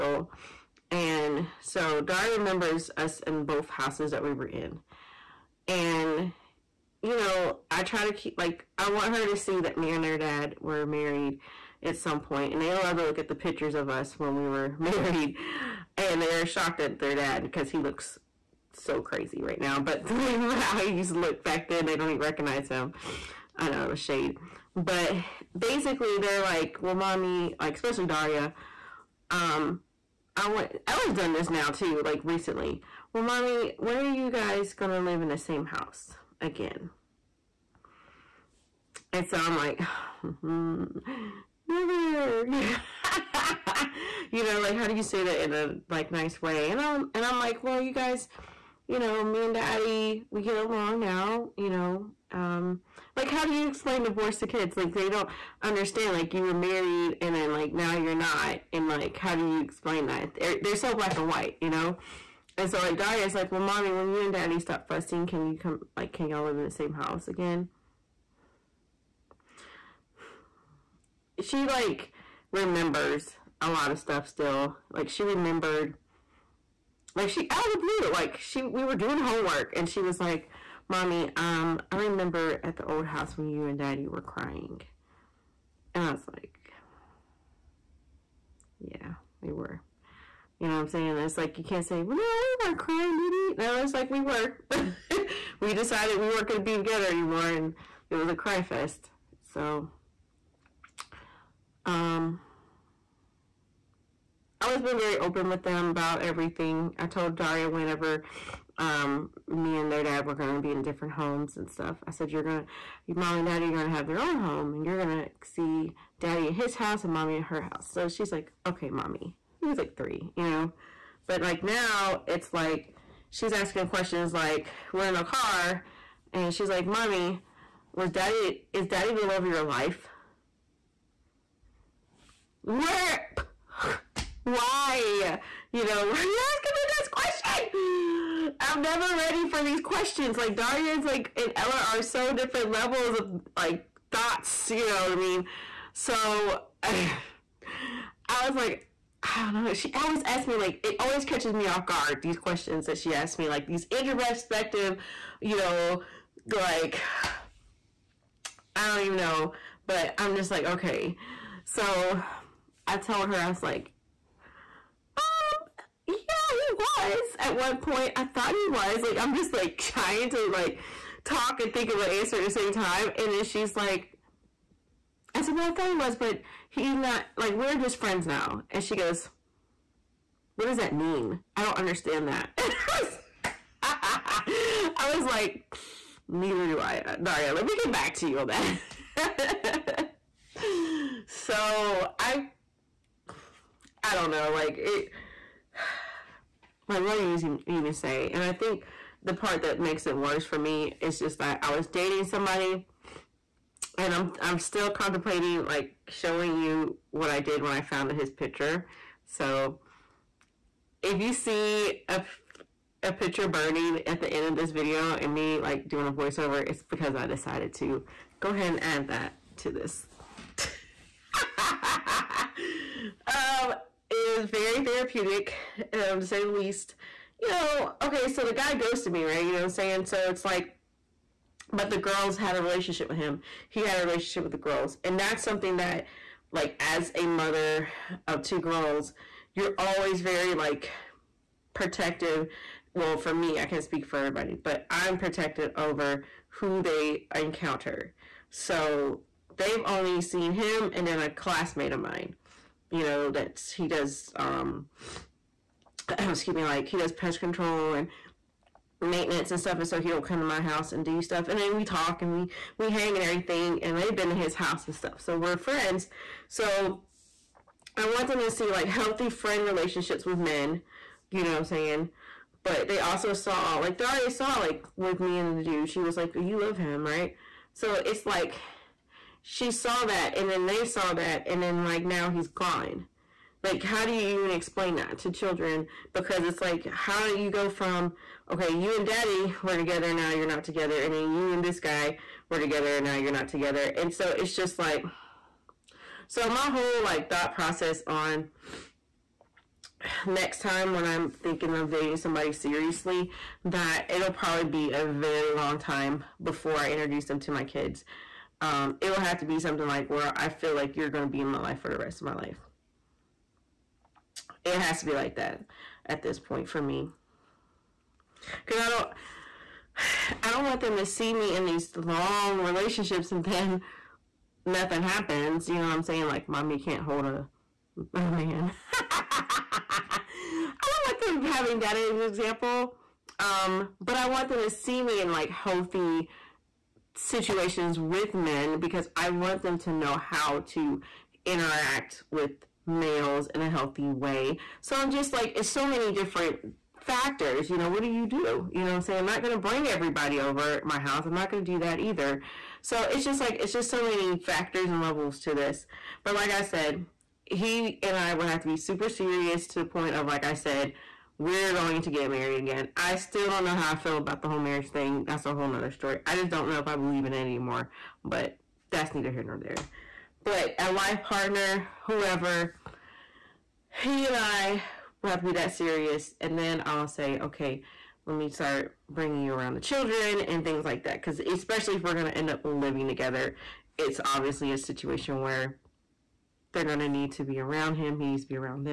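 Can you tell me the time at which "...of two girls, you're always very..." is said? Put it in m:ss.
3:58.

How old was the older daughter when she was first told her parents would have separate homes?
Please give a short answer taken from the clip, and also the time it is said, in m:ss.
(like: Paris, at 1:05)
3, at 1:59.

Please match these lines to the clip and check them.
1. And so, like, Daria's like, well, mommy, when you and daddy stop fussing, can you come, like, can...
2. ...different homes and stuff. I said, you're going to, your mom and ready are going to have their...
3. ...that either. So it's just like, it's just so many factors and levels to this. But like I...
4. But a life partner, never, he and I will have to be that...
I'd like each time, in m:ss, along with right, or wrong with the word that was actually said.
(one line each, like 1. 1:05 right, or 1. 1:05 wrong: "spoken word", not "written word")
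1. 1:02 right
2. 1:50 wrong: "daddy", not "ready"
3. 5:51 right
4. 6:10 wrong: "whoever", not "never".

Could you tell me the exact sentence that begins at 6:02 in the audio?
I still don't know how I feel about the whole marriage thing.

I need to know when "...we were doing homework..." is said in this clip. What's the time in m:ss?
1:18.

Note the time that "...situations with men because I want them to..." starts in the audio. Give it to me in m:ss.
5:37.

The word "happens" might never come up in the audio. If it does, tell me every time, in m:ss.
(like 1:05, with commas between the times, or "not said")
5:25.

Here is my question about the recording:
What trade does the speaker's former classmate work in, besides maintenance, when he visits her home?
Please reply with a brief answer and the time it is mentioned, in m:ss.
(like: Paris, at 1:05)
Pest control, at 4:17.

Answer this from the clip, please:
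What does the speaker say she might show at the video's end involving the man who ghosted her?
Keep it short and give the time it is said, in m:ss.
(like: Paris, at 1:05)
A picture burning, at 3:33.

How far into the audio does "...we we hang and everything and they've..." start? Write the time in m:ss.
4:22.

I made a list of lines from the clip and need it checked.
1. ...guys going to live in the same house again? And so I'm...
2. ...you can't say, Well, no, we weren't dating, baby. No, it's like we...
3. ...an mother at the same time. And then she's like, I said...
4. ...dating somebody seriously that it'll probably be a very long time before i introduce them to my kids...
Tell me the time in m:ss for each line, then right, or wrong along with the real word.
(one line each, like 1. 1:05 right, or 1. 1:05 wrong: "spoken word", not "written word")
1. 0:34 right
2. 1:31 wrong: "crying", not "dating"
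3. 2:52 wrong: "answer", not "mother"
4. 5:01 right.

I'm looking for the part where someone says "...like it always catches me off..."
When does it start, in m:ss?
2:30.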